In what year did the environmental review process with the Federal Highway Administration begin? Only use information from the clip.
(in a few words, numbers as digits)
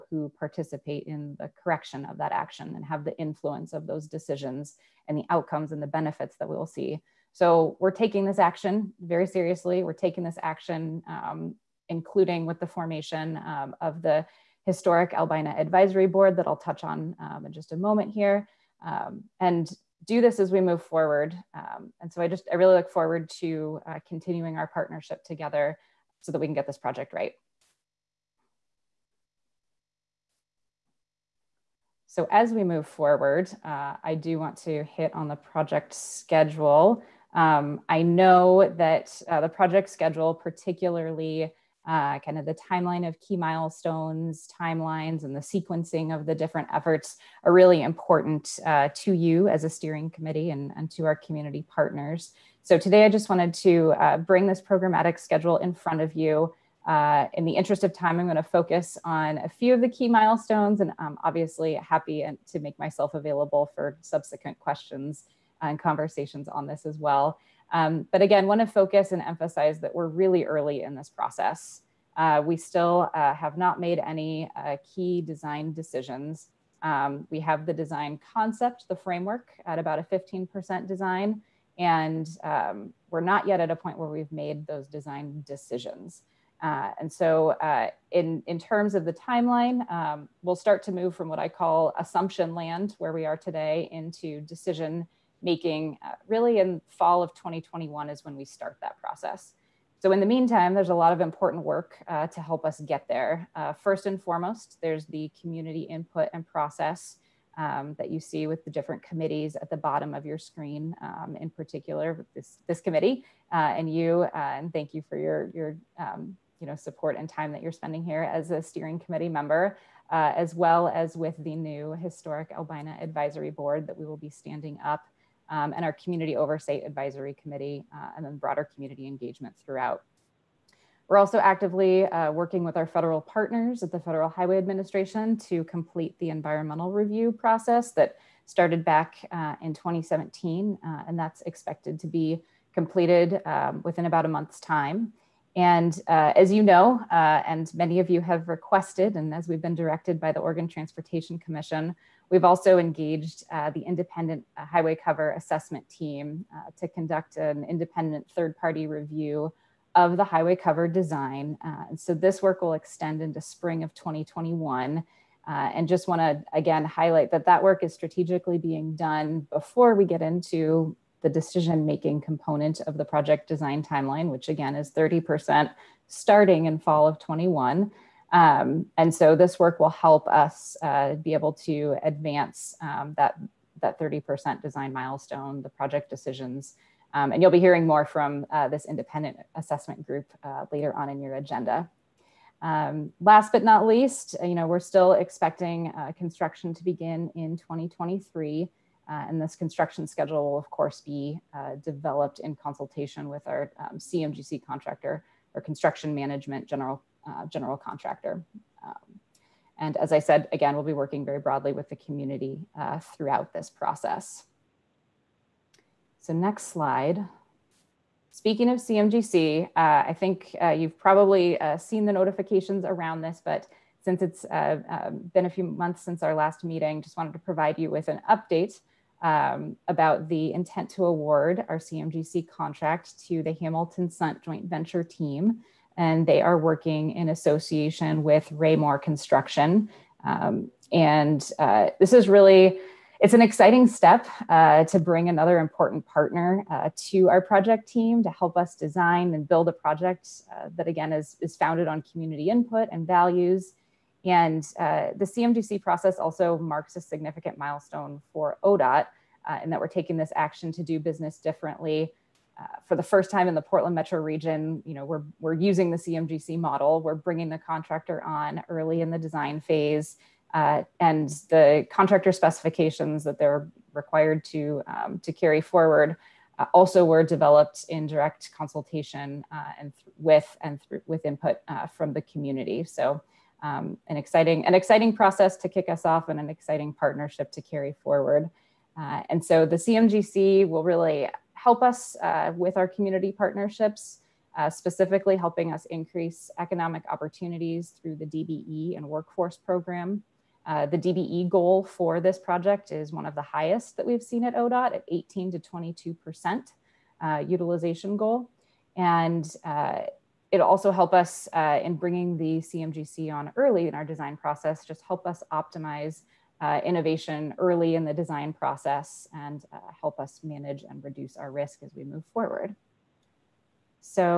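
2017.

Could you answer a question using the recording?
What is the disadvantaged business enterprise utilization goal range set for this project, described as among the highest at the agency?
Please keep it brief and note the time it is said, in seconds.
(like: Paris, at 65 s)
18 to 22%, at 305 s.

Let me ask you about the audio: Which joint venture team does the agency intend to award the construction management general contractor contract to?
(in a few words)
Hamilton Sundt.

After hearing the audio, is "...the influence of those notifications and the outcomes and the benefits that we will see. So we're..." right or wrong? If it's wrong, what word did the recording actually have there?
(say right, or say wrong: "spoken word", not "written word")
wrong: "decisions", not "notifications".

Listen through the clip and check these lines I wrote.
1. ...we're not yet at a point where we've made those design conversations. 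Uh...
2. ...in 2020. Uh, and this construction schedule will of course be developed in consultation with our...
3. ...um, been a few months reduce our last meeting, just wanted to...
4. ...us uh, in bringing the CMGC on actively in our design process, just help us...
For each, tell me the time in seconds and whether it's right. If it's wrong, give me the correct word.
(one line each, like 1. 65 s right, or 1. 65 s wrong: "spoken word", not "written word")
1. 83 s wrong: "decisions", not "conversations"
2. 197 s wrong: "2023", not "2020"
3. 224 s wrong: "since", not "reduce"
4. 311 s wrong: "early", not "actively".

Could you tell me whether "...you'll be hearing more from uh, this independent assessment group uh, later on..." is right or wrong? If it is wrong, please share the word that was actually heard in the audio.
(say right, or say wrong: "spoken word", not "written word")
right.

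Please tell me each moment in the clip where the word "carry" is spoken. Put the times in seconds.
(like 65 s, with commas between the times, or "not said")
275 s, 287 s.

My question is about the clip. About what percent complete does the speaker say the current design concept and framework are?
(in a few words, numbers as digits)
15%.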